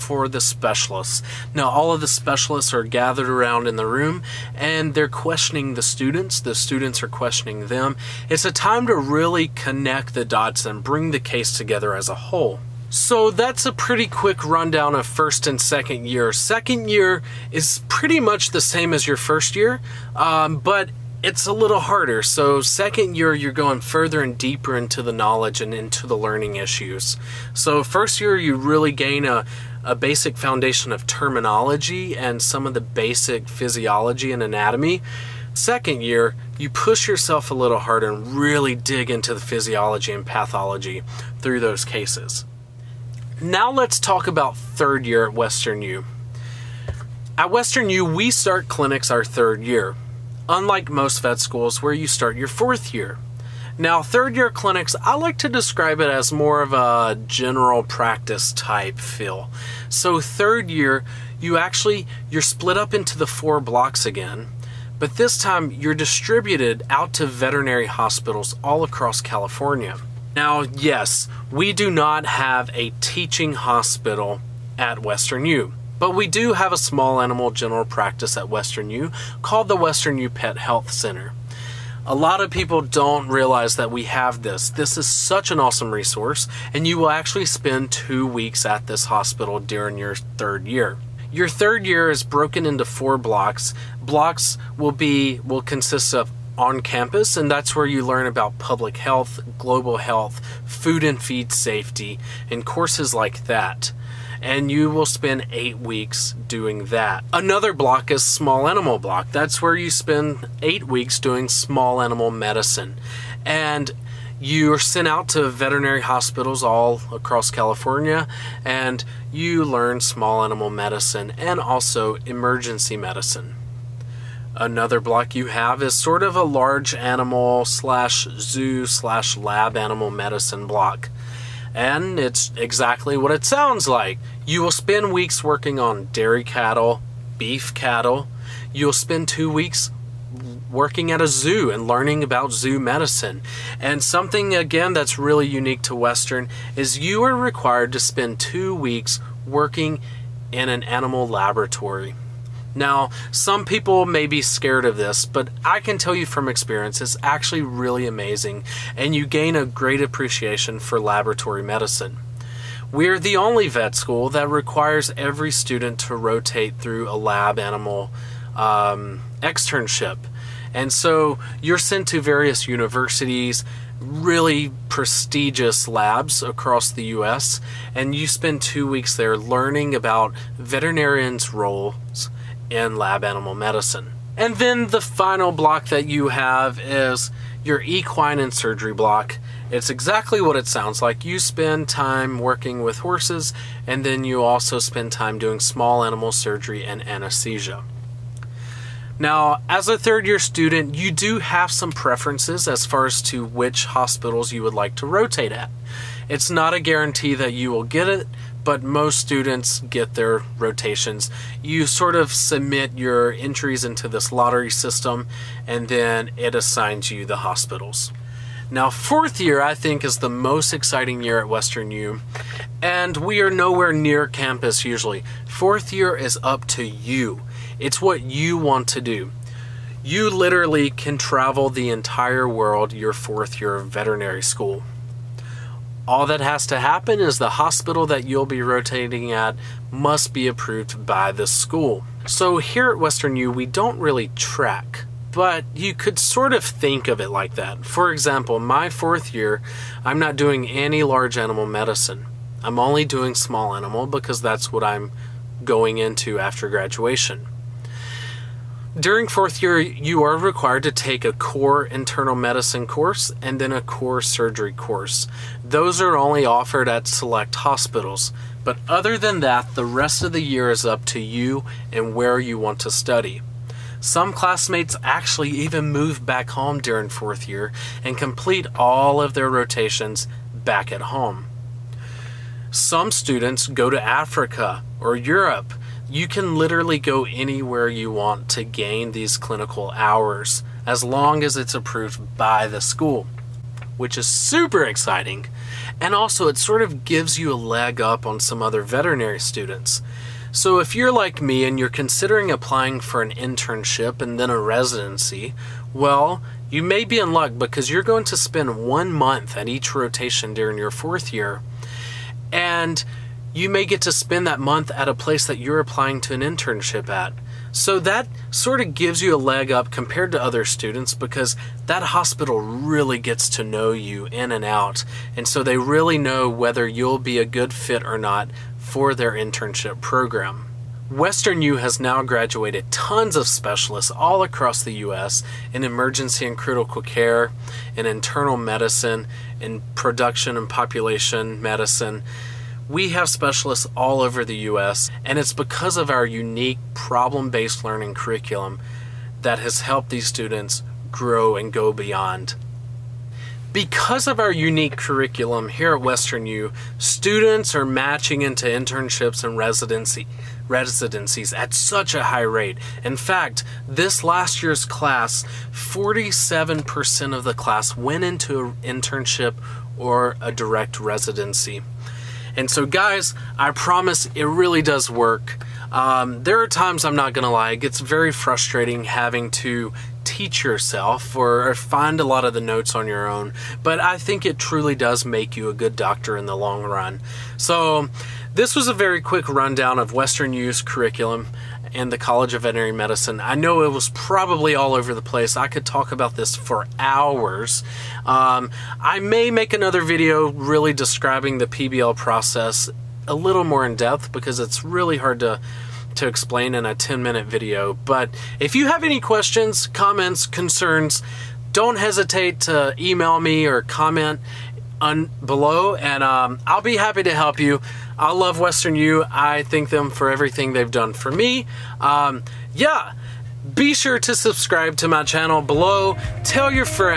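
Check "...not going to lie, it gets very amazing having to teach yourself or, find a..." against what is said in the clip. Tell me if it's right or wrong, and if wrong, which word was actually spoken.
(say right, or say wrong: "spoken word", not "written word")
wrong: "frustrating", not "amazing".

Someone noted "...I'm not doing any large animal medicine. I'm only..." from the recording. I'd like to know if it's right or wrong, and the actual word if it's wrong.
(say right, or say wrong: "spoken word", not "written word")
right.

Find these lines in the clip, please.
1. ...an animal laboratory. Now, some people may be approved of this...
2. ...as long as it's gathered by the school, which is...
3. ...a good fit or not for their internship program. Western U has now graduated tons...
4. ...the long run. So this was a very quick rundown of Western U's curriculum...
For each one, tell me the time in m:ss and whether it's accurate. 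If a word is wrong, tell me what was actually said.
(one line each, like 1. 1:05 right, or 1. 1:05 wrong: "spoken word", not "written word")
1. 2:30 wrong: "scared", not "approved"
2. 4:50 wrong: "approved", not "gathered"
3. 5:27 right
4. 6:26 right.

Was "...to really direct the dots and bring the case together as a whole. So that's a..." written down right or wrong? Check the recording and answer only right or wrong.
wrong.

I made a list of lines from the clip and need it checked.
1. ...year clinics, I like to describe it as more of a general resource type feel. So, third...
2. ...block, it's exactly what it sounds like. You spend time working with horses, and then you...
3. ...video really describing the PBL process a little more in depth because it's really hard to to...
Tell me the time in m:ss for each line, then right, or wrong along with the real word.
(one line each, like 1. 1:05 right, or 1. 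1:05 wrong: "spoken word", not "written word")
1. 0:54 wrong: "practice", not "resource"
2. 3:08 right
3. 6:40 right.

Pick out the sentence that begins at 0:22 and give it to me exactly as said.
So second year, you're going further and deeper into the knowledge and into the learning issues.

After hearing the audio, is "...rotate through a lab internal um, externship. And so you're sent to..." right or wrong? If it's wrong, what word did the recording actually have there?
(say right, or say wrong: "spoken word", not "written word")
wrong: "animal", not "internal".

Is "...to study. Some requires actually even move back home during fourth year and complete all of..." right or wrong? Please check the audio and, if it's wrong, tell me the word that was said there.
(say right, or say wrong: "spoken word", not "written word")
wrong: "classmates", not "requires".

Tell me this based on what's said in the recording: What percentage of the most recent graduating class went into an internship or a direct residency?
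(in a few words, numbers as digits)
47%.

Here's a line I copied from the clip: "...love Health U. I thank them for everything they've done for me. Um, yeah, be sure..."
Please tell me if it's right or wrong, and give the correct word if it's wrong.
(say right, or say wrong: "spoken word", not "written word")
wrong: "Western", not "Health".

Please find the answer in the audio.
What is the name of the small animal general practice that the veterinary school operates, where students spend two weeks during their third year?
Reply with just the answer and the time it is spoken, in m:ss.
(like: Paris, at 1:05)
Western U Pet Health Center, at 1:19.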